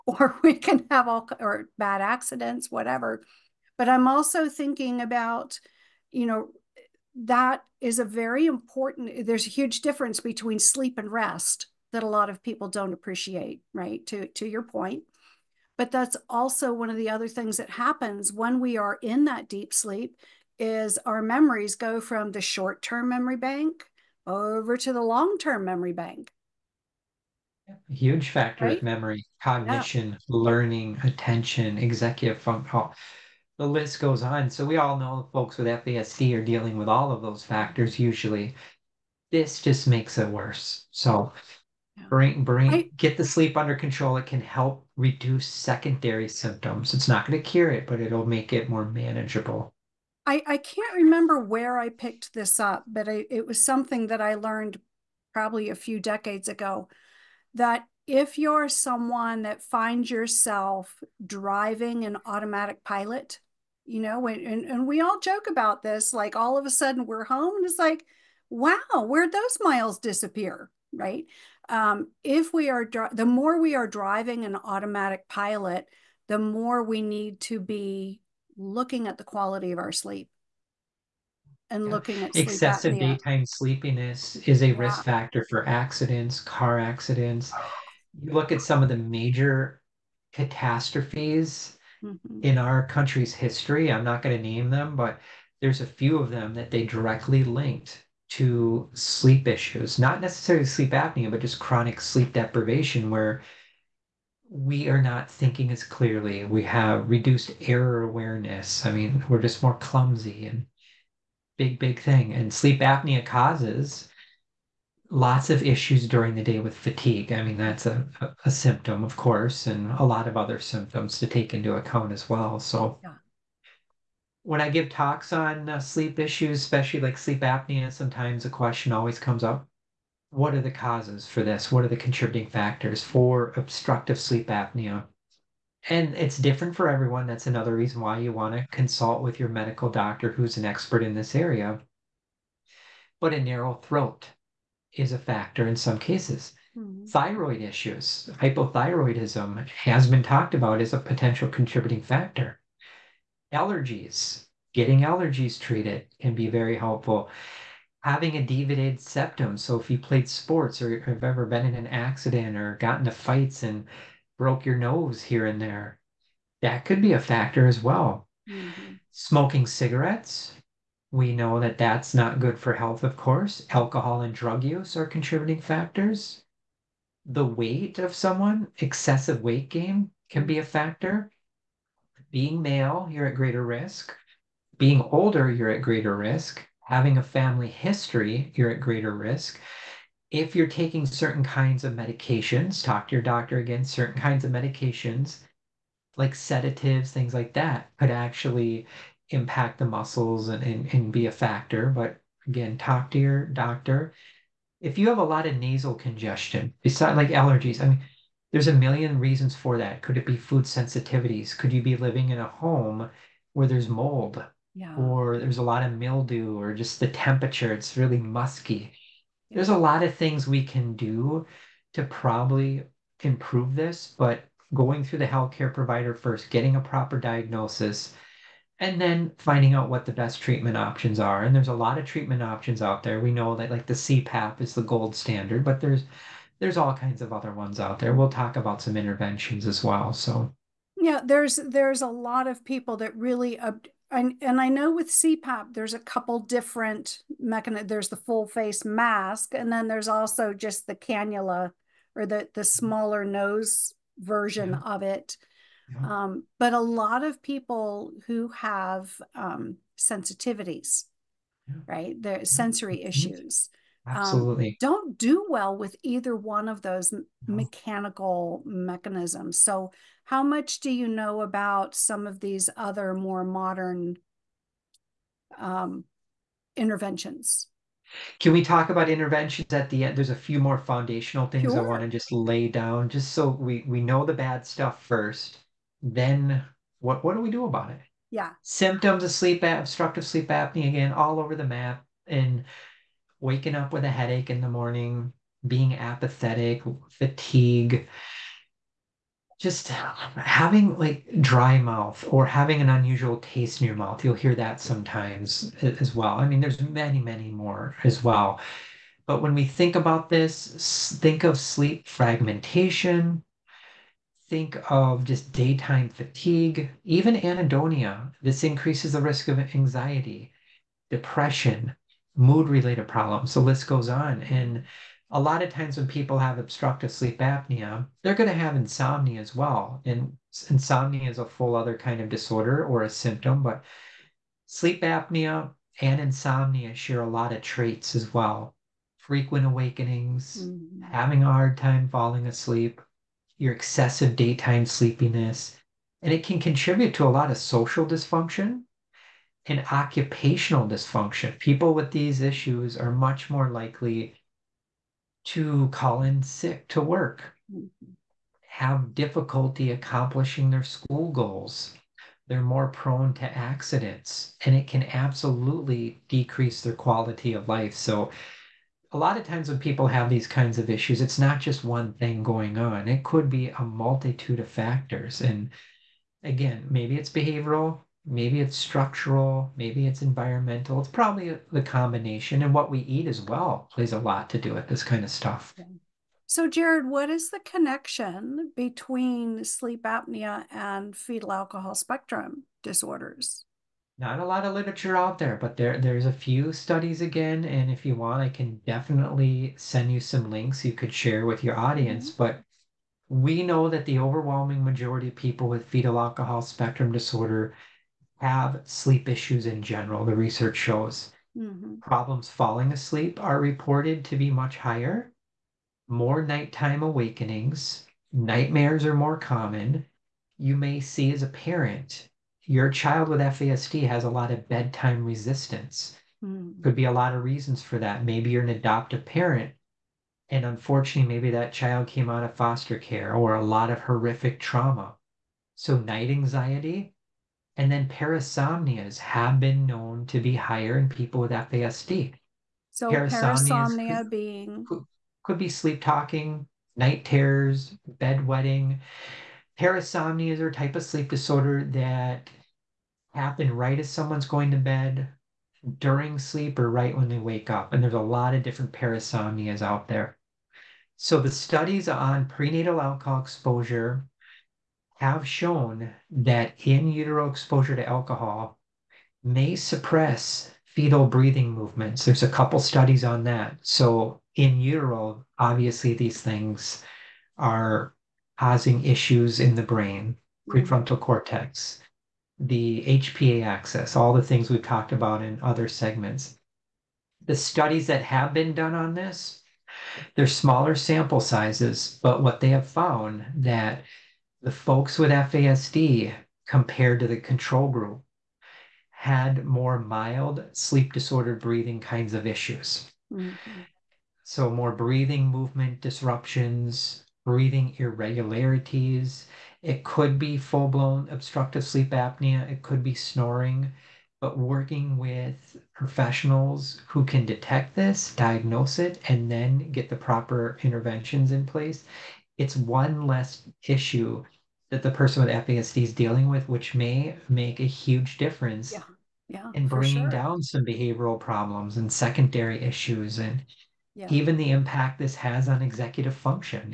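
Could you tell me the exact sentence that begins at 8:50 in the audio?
down some behavioral problems and secondary issues and yeah.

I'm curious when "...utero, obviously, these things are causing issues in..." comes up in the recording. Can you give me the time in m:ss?
7:54.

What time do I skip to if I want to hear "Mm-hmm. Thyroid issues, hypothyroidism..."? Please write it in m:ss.
2:26.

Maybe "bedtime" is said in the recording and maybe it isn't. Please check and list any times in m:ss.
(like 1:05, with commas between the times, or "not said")
7:04.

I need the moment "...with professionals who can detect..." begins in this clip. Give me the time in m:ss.
8:35.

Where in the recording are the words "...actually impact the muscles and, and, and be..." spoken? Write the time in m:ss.
3:18.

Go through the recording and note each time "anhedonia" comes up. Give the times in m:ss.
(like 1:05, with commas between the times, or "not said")
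5:17.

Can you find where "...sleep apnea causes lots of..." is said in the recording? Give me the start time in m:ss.
1:52.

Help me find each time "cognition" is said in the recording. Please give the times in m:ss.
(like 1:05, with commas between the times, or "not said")
0:29.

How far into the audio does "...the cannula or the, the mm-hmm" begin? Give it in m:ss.
4:10.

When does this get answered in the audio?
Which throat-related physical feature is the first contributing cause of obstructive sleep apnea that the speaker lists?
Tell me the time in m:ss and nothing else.
2:23.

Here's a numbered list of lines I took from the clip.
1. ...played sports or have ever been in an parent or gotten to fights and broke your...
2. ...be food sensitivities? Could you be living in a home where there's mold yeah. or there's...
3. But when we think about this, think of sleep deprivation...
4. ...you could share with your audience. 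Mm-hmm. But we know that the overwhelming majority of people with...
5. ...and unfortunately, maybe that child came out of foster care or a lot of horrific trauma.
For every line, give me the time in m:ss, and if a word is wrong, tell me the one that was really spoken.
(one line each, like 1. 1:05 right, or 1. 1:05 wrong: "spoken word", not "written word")
1. 2:39 wrong: "accident", not "parent"
2. 3:30 right
3. 5:09 wrong: "fragmentation", not "deprivation"
4. 6:40 right
5. 7:10 right.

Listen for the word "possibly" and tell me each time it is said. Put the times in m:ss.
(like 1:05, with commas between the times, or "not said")
not said.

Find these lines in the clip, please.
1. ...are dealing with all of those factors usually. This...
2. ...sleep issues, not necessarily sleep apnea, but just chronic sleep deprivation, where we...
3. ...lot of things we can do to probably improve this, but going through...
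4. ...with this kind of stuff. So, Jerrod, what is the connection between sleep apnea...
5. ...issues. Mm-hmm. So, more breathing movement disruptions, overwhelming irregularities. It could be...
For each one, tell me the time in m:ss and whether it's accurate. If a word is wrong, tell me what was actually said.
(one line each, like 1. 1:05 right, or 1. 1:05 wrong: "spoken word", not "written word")
1. 0:36 right
2. 1:38 right
3. 3:39 right
4. 6:24 right
5. 8:22 wrong: "breathing", not "overwhelming".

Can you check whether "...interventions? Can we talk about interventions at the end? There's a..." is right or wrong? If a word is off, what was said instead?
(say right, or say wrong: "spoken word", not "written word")
right.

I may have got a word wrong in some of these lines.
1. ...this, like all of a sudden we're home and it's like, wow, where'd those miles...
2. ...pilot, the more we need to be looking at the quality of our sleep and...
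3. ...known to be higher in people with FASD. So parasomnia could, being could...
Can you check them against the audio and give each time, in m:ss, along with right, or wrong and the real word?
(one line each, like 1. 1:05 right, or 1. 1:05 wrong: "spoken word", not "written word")
1. 1:05 right
2. 1:15 right
3. 7:19 right.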